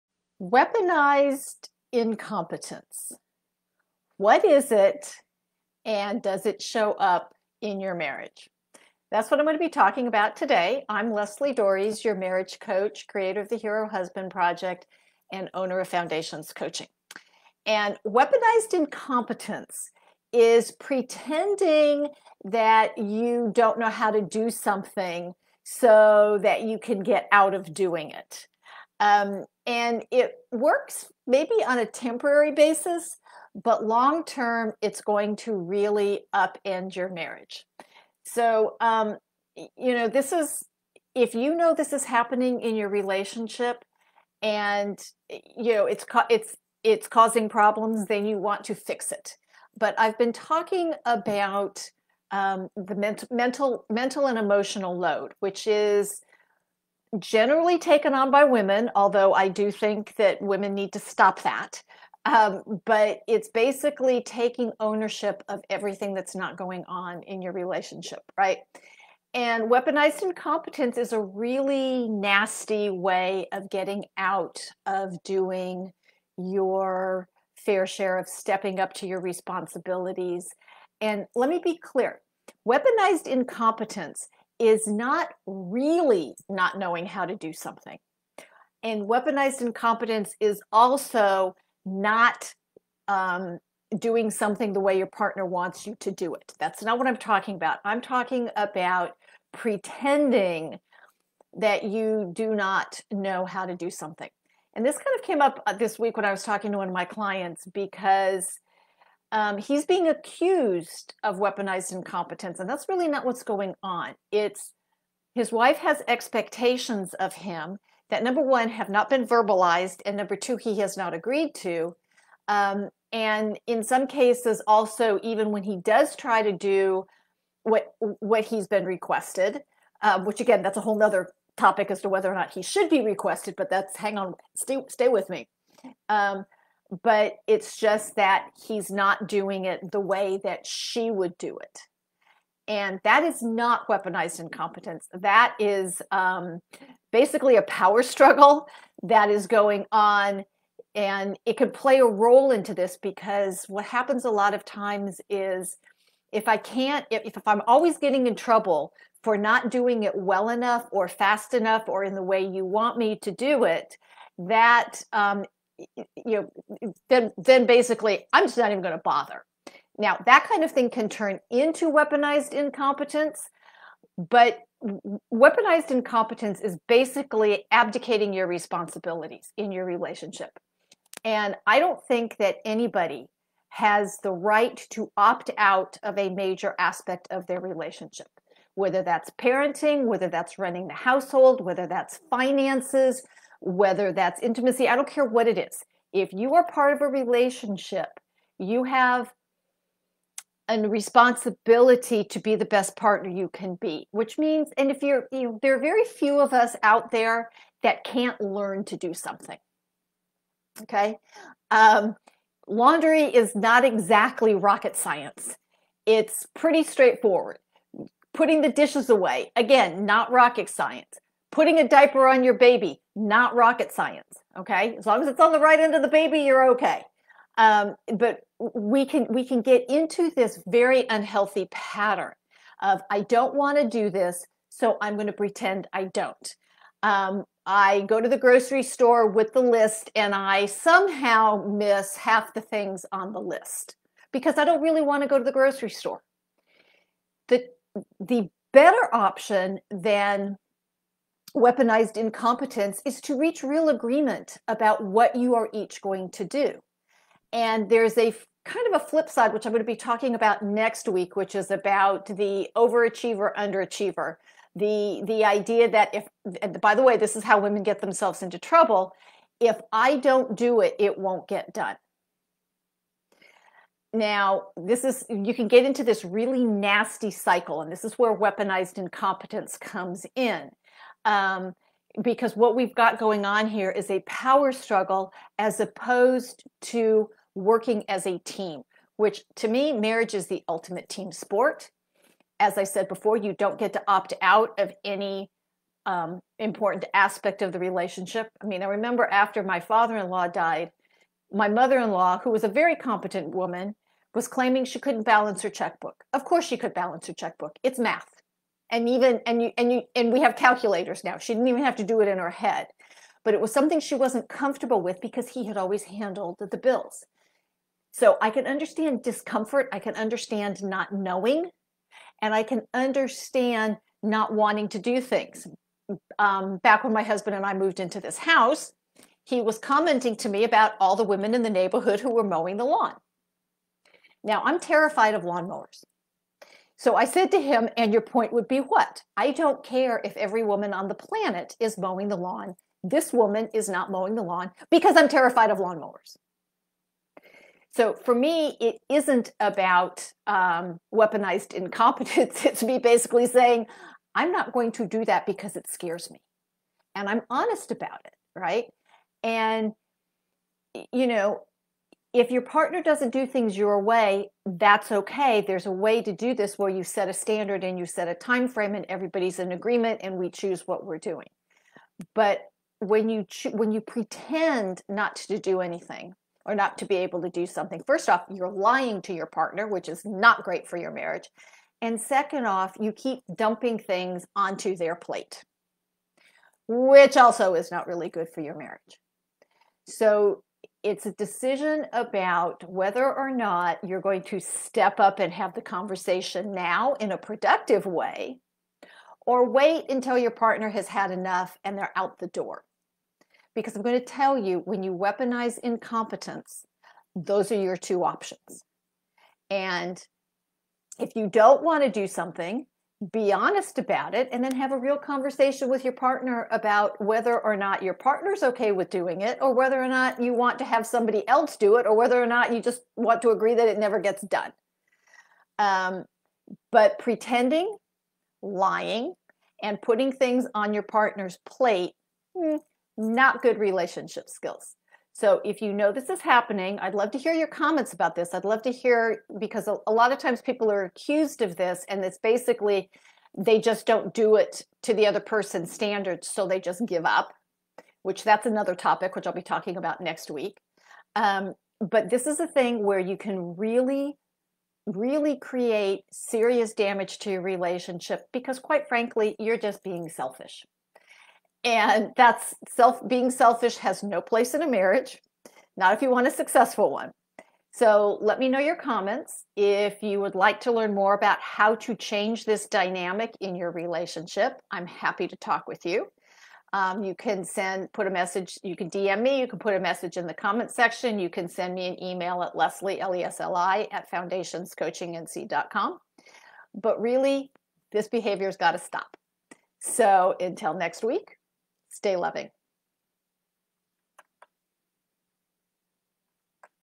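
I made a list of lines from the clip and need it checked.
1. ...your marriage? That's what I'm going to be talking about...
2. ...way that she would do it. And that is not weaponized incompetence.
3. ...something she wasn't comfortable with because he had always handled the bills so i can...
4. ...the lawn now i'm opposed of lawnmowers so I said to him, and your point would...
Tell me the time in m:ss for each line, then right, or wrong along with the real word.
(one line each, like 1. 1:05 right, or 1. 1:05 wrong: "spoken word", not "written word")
1. 0:07 right
2. 2:19 right
3. 5:13 right
4. 5:32 wrong: "terrified", not "opposed".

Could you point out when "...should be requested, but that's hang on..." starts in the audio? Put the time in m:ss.
2:12.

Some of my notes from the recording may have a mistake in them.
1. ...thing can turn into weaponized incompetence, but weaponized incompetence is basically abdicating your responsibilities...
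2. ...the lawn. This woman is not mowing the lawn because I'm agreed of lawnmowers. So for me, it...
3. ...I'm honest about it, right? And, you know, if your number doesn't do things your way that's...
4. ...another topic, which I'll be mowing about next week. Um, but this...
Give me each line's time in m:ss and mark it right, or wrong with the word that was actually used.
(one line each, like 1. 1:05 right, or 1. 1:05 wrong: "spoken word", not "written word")
1. 2:50 right
2. 5:42 wrong: "terrified", not "agreed"
3. 5:57 wrong: "partner", not "number"
4. 7:28 wrong: "talking", not "mowing".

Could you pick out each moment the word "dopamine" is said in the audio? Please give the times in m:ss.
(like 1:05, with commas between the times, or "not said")
not said.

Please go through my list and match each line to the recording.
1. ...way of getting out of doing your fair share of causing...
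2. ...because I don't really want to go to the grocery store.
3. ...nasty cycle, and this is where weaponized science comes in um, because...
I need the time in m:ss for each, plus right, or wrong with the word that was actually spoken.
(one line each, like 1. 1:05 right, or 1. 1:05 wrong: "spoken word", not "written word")
1. 1:12 wrong: "stepping", not "causing"
2. 4:04 right
3. 4:36 wrong: "incompetence", not "science".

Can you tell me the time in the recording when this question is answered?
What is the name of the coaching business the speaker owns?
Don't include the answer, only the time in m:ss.
0:15.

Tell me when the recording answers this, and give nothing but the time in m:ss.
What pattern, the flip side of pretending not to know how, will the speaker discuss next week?
4:22.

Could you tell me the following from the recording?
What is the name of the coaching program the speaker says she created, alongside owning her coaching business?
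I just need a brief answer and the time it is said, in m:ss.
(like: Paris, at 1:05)
Hero Husband Project, at 0:13.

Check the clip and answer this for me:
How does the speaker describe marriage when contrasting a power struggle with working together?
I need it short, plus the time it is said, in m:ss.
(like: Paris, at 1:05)
the ultimate team sport, at 4:50.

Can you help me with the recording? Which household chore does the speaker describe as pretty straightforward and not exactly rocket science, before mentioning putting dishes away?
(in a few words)
laundry.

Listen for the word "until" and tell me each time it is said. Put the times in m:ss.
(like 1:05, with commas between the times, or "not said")
6:40, 8:10.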